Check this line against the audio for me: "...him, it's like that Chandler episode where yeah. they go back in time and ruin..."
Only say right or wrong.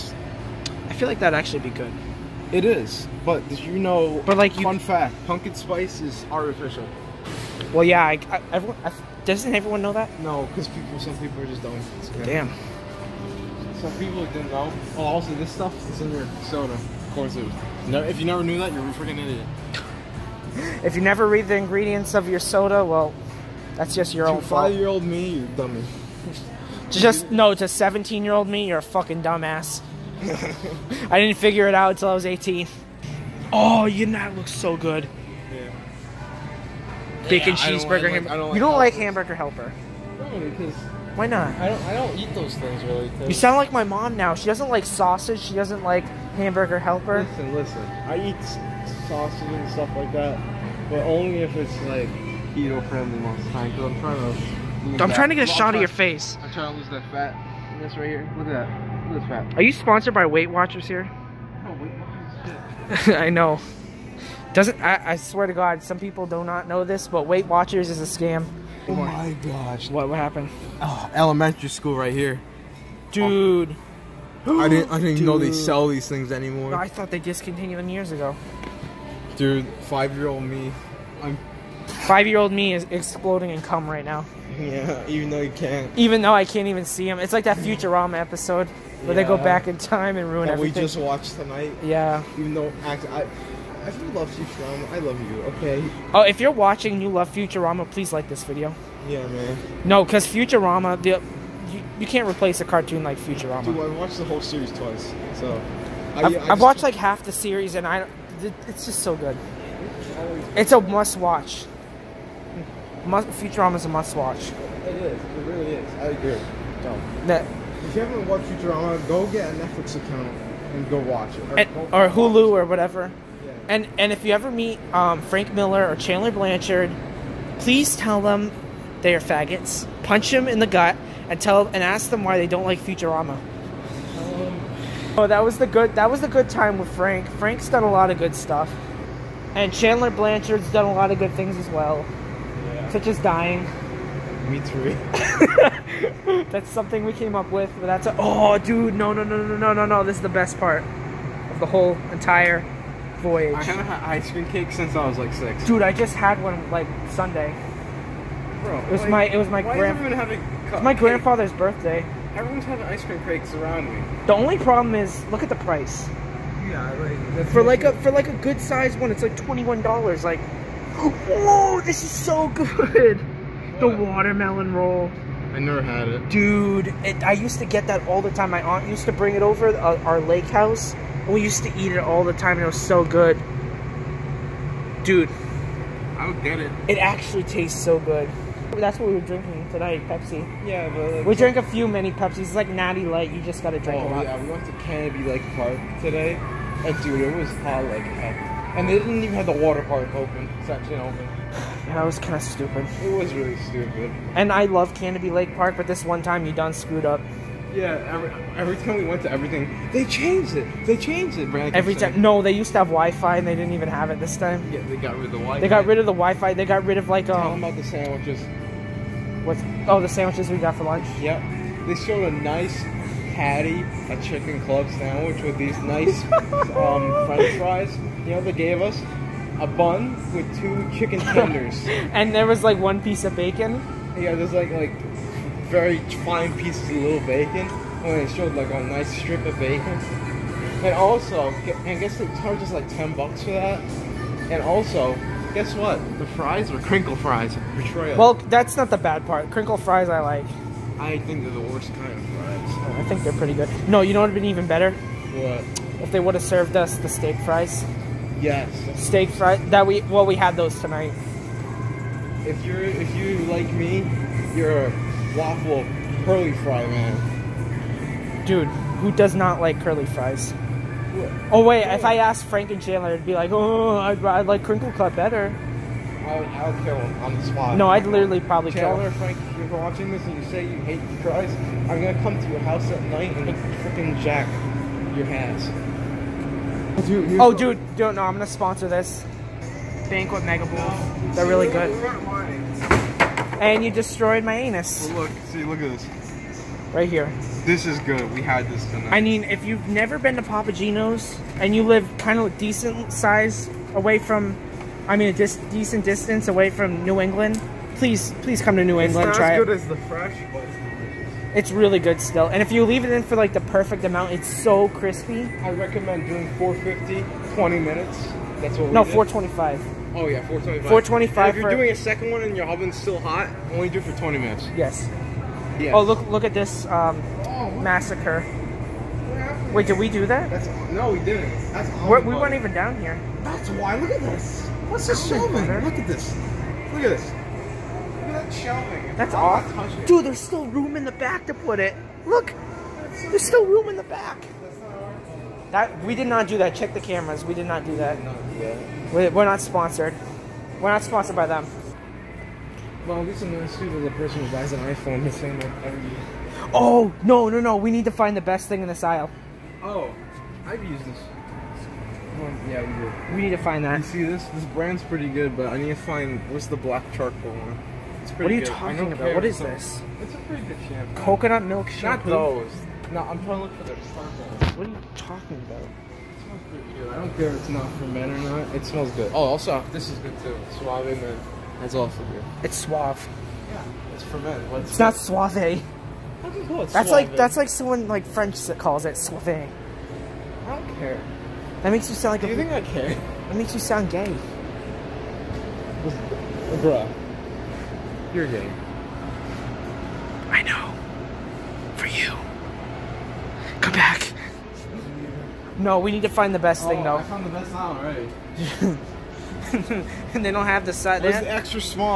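wrong.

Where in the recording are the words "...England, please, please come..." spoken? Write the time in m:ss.
5:07.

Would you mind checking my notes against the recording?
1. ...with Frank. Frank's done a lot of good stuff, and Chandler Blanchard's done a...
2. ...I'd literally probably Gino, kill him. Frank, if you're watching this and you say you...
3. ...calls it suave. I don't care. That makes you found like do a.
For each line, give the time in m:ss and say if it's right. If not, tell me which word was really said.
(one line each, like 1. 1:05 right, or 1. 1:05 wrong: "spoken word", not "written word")
1. 2:16 right
2. 4:37 wrong: "Chandler", not "Gino"
3. 6:28 wrong: "sound", not "found".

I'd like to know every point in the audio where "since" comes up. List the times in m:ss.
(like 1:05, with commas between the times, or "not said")
2:34.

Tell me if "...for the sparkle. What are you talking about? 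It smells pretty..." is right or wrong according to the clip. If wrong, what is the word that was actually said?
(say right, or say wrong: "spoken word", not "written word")
right.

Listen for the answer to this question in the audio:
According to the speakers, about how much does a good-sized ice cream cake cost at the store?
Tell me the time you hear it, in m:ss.
2:49.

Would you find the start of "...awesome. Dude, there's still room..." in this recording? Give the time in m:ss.
5:39.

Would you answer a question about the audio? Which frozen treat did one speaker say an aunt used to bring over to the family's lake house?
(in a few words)
Watermelon roll.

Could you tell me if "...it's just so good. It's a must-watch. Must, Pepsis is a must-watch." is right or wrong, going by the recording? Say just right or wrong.
wrong.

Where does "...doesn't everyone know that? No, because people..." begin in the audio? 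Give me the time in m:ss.
0:09.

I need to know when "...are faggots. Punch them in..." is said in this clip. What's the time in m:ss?
2:09.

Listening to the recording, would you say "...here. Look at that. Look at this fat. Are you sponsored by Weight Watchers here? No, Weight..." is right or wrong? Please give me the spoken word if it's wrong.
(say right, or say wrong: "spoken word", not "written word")
right.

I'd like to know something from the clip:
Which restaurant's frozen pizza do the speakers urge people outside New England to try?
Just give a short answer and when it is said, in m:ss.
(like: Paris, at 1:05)
Papa Gino's, at 5:00.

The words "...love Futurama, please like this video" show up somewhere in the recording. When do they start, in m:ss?
1:37.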